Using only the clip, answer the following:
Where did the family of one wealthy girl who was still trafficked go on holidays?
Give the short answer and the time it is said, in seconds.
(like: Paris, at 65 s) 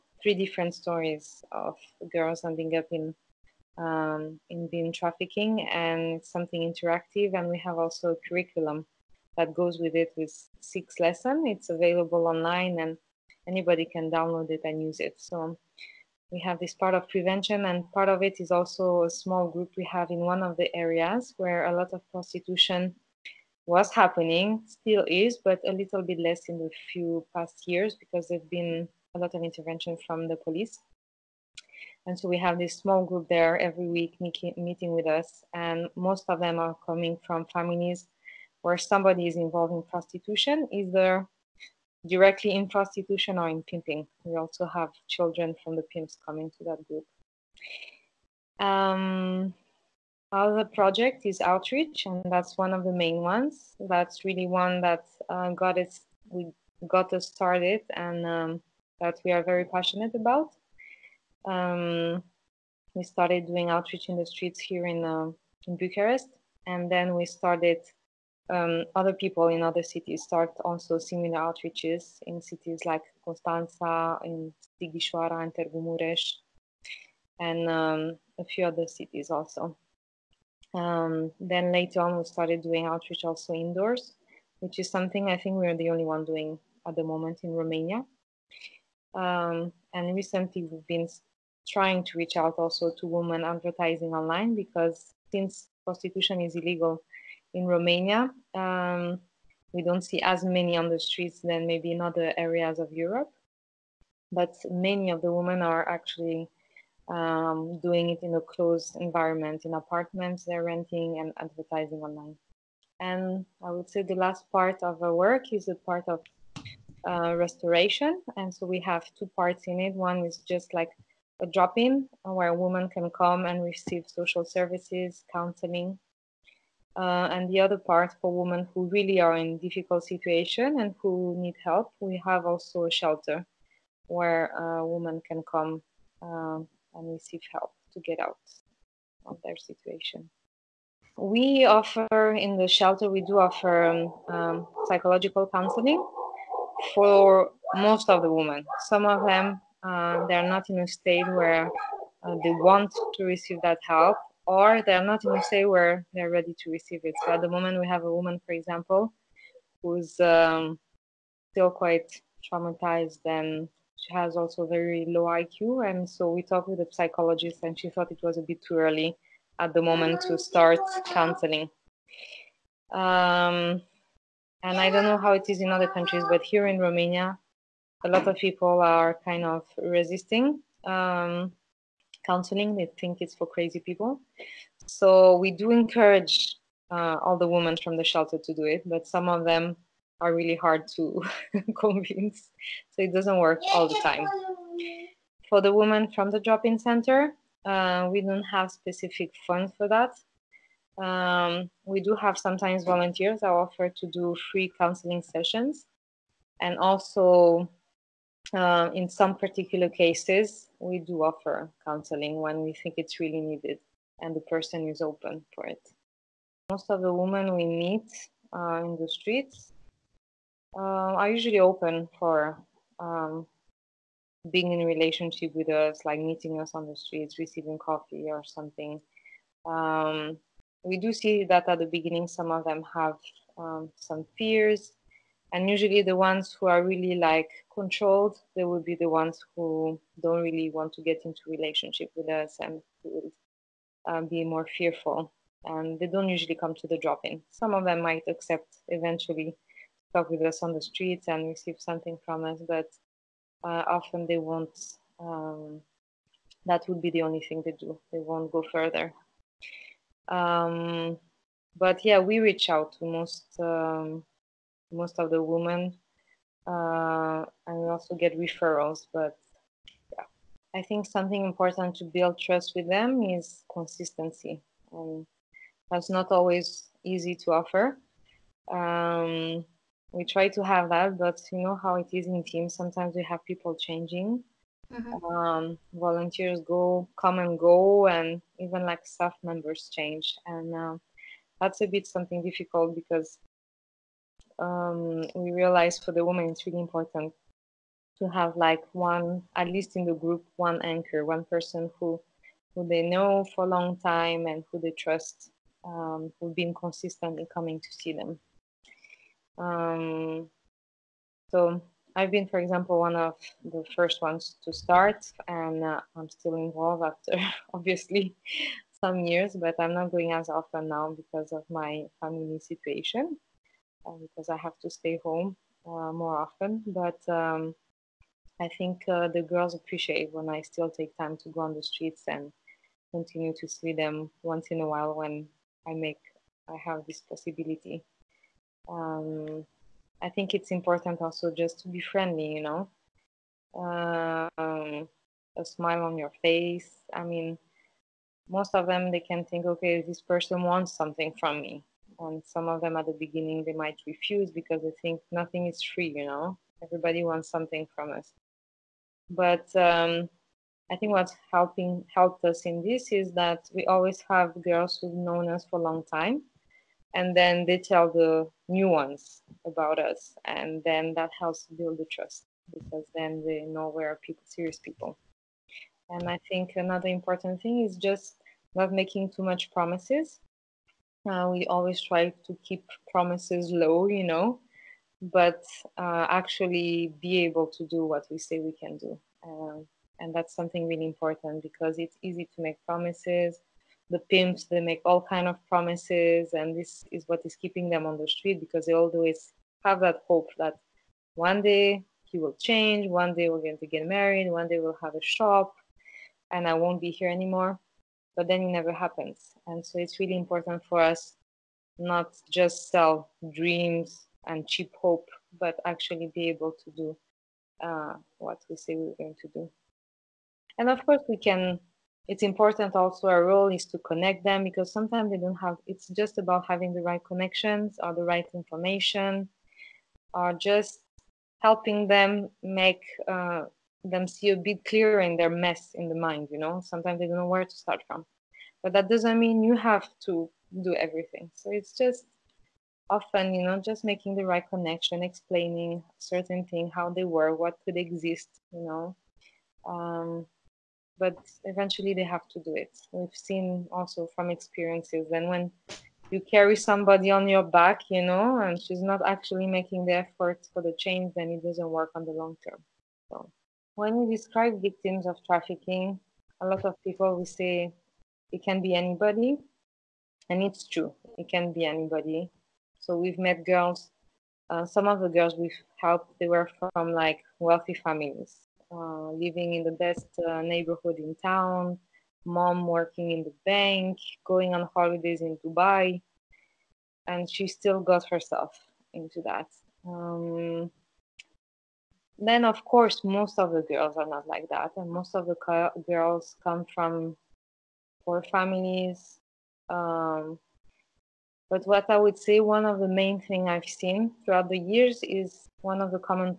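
Dubai, at 485 s.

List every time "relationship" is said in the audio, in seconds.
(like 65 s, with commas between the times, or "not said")
224 s, 241 s.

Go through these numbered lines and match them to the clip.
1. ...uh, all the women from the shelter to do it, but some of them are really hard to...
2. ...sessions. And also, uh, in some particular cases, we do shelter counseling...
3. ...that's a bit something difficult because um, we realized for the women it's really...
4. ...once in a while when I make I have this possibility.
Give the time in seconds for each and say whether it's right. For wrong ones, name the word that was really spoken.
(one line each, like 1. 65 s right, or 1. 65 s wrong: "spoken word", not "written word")
1. 186 s right
2. 205 s wrong: "offer", not "shelter"
3. 291 s right
4. 334 s right.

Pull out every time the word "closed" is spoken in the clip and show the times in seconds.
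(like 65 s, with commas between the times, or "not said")
108 s.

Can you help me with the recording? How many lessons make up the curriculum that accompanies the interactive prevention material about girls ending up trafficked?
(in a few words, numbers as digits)
6.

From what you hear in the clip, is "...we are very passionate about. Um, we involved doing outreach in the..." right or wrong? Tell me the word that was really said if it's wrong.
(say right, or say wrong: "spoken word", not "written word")
wrong: "started", not "involved".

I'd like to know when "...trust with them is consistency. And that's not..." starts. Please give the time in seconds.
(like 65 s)
272 s.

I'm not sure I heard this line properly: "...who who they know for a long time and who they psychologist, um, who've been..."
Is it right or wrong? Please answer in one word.
wrong.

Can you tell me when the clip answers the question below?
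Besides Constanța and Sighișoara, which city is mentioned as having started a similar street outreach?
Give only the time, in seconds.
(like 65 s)
75 s.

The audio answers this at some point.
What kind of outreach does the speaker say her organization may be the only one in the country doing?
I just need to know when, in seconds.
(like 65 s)
83 s.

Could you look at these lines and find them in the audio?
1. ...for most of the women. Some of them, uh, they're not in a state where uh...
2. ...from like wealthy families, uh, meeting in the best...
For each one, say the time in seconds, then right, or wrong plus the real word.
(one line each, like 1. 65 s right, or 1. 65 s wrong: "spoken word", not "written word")
1. 146 s right
2. 476 s wrong: "living", not "meeting".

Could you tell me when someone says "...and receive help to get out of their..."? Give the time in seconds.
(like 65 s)
136 s.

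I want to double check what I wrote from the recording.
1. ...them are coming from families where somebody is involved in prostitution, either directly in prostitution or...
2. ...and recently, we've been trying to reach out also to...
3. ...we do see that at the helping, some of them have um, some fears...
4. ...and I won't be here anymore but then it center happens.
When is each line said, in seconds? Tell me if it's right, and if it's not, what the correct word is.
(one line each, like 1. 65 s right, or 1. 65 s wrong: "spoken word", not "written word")
1. 36 s right
2. 89 s right
3. 230 s wrong: "beginning", not "helping"
4. 406 s wrong: "never", not "center".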